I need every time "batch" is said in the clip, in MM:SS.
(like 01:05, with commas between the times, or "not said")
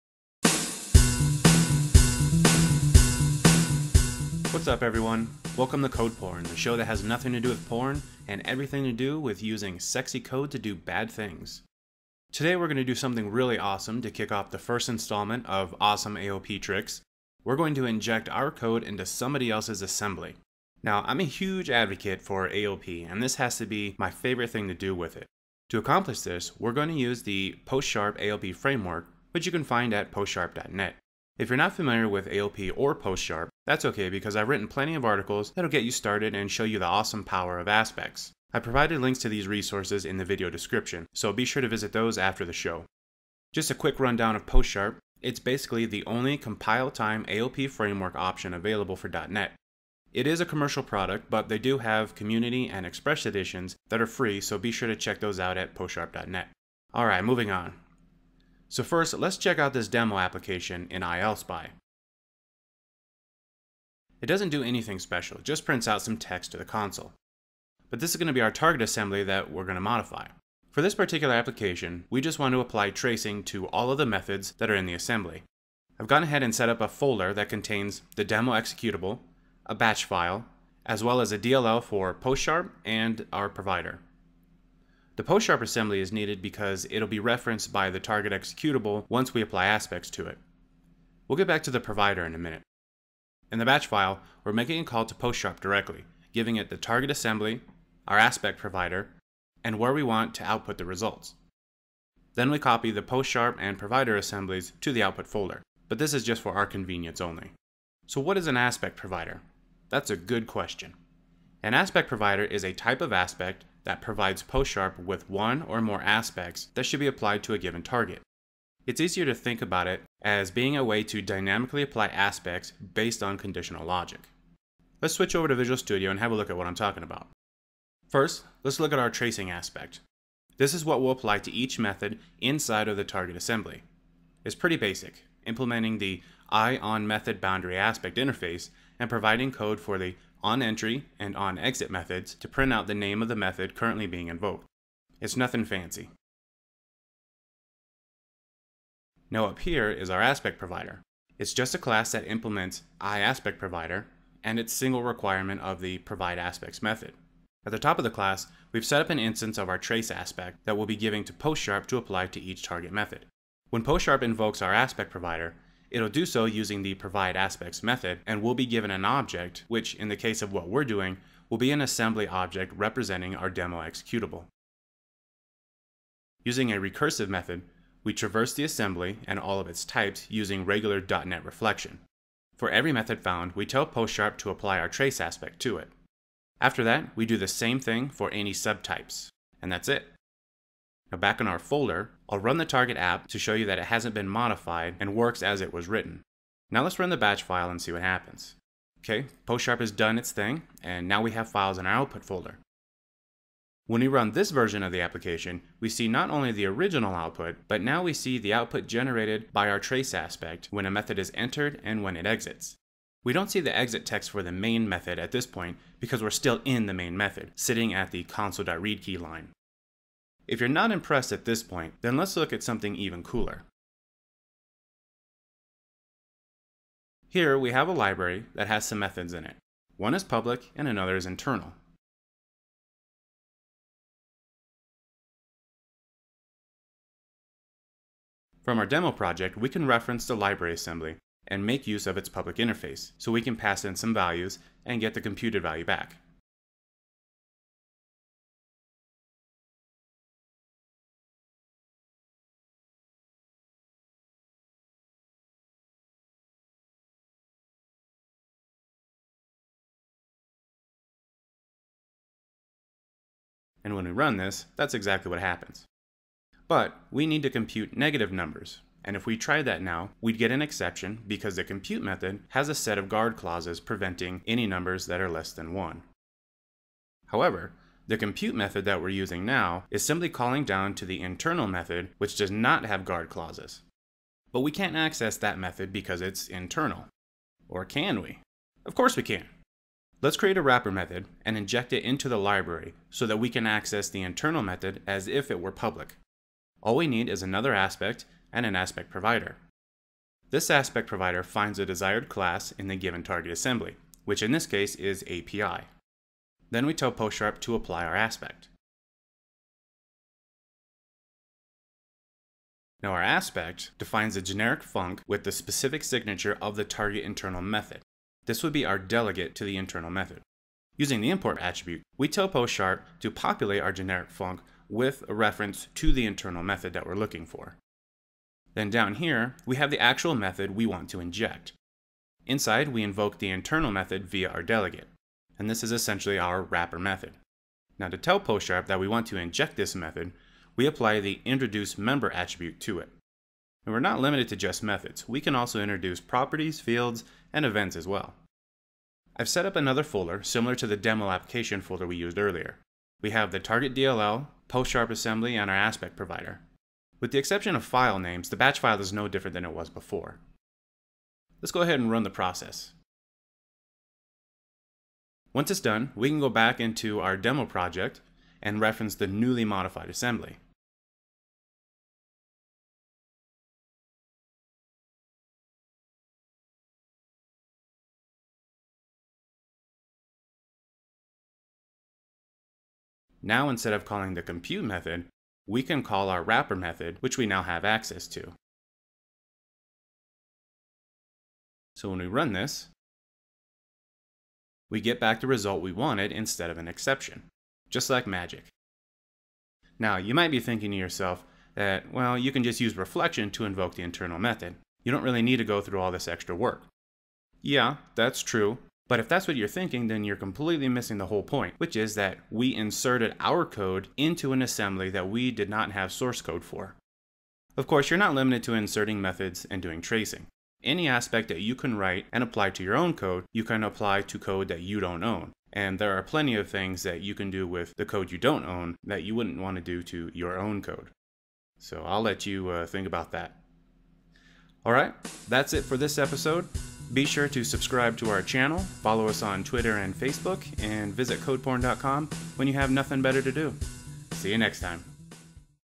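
01:19, 01:33, 03:17, 05:58.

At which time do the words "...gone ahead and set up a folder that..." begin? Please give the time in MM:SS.
01:16.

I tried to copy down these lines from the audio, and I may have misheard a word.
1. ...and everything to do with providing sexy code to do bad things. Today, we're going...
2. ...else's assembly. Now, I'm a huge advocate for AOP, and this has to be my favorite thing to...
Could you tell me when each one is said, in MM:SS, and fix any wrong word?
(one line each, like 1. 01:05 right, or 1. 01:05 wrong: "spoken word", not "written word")
1. 00:08 wrong: "using", not "providing"
2. 00:19 right.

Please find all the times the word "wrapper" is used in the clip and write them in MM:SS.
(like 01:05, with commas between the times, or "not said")
04:50, 05:36, 06:26.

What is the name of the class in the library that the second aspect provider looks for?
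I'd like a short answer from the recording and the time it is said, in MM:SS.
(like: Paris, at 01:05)
API, at 05:05.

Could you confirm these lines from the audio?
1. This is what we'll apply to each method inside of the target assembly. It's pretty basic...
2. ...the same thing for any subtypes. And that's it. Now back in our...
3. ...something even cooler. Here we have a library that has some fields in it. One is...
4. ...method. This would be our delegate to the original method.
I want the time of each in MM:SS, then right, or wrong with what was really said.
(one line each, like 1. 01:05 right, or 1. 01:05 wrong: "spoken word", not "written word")
1. 02:10 right
2. 03:07 right
3. 03:42 wrong: "methods", not "fields"
4. 05:17 wrong: "internal", not "original".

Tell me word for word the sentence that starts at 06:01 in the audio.
Let's go ahead and run the process.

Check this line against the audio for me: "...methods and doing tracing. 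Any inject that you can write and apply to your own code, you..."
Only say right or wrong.
wrong.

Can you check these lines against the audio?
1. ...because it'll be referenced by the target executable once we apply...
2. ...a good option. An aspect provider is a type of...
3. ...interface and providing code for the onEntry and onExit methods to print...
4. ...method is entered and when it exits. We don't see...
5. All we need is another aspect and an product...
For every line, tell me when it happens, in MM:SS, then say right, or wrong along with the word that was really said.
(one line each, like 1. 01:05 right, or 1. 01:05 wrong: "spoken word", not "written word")
1. 01:26 right
2. 01:50 wrong: "question", not "option"
3. 02:18 right
4. 03:30 right
5. 04:56 wrong: "aspect", not "product".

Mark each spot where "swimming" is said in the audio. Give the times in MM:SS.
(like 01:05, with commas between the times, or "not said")
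not said.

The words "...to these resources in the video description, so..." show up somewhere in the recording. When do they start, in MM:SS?
00:39.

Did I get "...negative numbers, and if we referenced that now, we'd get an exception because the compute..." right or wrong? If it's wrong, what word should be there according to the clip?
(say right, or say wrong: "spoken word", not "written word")
wrong: "tried", not "referenced".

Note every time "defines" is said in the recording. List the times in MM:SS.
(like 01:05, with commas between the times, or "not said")
05:13.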